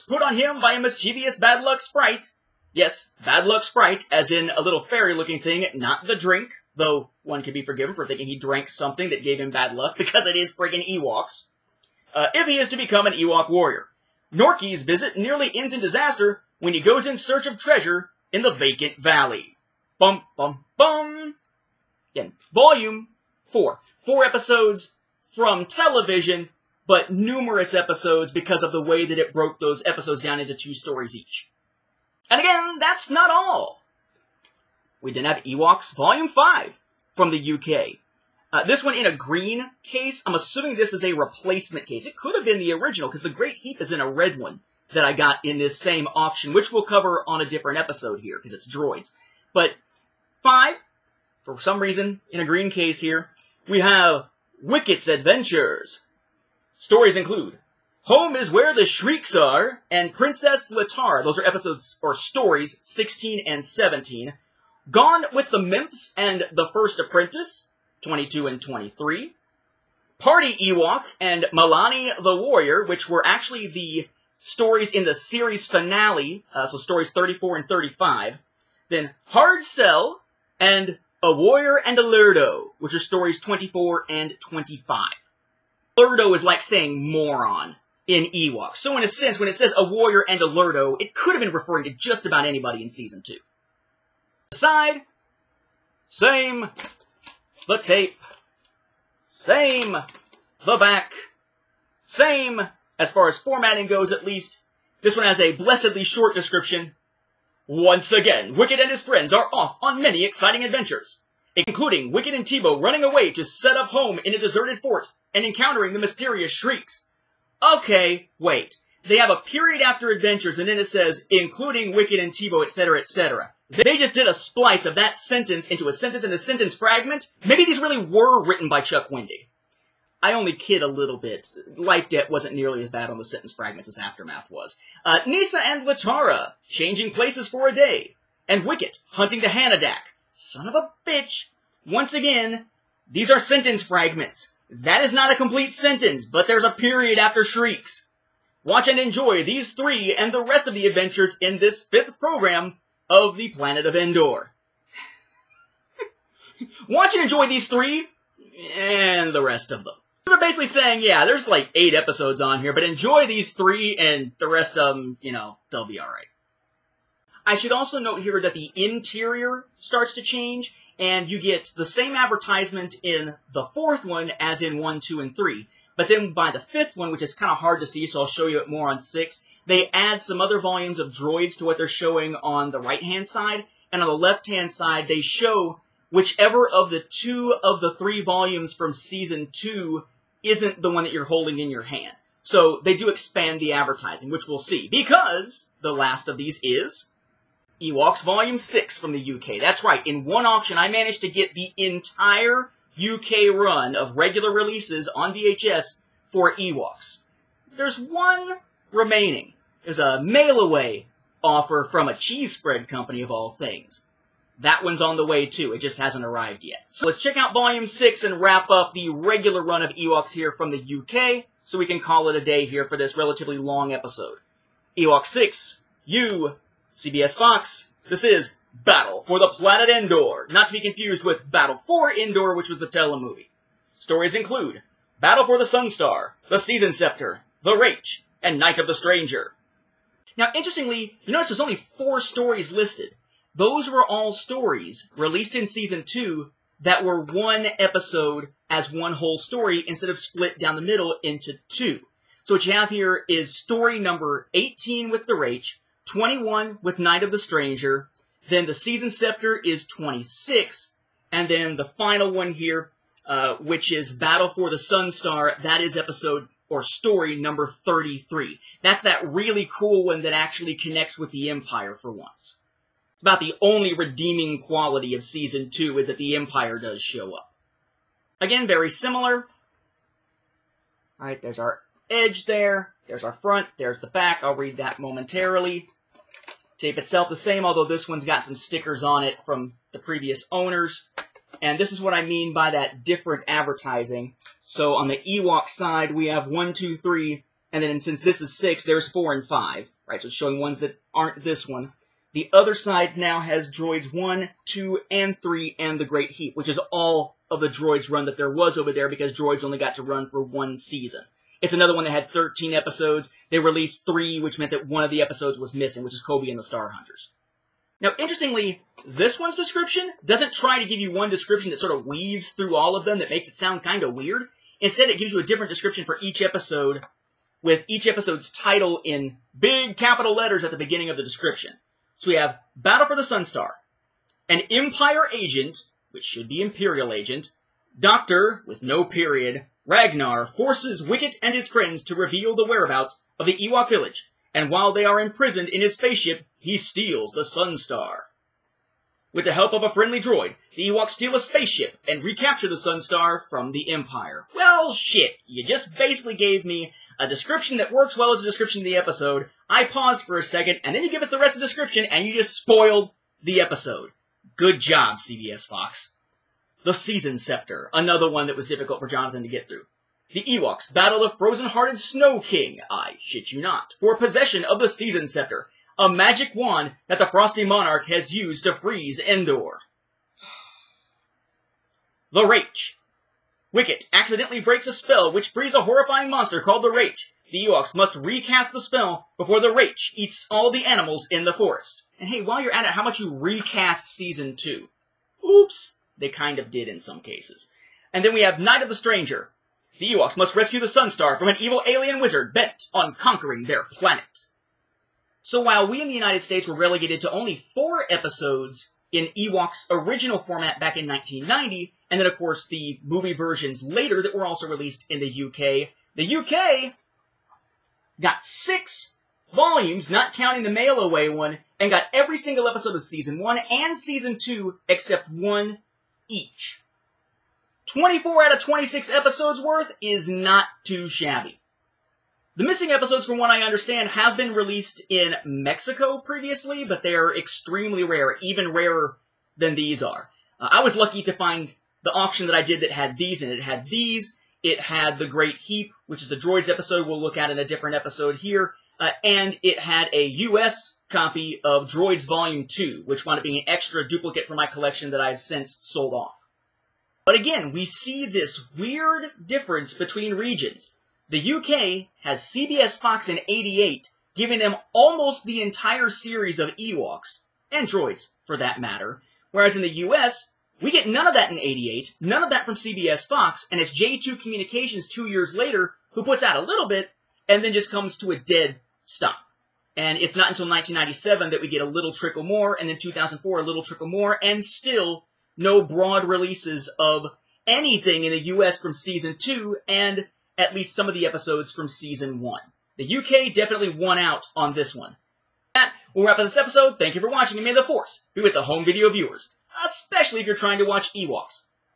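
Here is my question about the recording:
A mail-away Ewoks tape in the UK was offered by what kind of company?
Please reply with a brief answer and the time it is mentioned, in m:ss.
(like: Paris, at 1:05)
A cheese spread company, at 3:32.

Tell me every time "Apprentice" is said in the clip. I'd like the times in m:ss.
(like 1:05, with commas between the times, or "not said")
1:06.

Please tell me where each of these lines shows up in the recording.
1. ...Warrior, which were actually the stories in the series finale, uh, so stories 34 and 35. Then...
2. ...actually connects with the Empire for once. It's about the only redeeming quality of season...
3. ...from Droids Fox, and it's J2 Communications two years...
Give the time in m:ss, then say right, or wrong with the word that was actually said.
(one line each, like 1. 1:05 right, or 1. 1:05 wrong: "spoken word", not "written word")
1. 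1:12 right
2. 4:30 right
3. 7:52 wrong: "CBS", not "Droids".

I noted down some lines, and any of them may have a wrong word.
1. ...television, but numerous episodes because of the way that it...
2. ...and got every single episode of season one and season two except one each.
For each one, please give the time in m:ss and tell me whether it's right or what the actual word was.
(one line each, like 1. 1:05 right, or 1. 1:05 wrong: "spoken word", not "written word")
1. 0:25 right
2. 7:01 right.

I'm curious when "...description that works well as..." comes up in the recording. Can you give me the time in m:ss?
5:57.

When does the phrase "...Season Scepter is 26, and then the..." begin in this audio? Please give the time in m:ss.
4:18.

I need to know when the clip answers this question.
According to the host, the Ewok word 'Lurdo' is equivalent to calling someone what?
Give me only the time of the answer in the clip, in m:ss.
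1:27.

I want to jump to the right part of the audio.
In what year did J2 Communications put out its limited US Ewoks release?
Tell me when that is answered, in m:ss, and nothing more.
6:51.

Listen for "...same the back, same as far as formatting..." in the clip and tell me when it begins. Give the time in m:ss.
1:39.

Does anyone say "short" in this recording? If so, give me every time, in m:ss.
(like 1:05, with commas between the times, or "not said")
1:46.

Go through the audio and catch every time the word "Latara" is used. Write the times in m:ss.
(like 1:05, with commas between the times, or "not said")
1:00, 2:15.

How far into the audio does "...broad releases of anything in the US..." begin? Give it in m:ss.
8:05.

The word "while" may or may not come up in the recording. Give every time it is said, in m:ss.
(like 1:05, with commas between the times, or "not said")
5:44, 6:32, 6:45.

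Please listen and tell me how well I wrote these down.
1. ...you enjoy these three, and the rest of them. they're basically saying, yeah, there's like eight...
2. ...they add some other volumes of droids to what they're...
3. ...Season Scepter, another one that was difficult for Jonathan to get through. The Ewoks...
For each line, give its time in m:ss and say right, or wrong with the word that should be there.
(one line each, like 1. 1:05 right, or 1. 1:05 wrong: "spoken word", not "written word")
1. 2:37 right
2. 2:59 right
3. 6:06 right.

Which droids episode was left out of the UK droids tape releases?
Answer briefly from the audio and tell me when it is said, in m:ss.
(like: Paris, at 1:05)
Coby and the Star Hunters, at 5:16.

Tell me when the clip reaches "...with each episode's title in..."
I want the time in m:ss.
5:27.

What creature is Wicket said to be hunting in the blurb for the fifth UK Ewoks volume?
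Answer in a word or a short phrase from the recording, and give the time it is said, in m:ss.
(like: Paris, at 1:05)
The Hanadak, at 2:19.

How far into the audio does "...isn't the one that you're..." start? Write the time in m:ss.
3:10.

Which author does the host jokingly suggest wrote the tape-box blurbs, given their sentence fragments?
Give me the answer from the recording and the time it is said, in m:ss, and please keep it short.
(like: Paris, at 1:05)
Chuck Wendig, at 2:08.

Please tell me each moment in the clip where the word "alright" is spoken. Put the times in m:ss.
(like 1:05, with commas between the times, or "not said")
2:45.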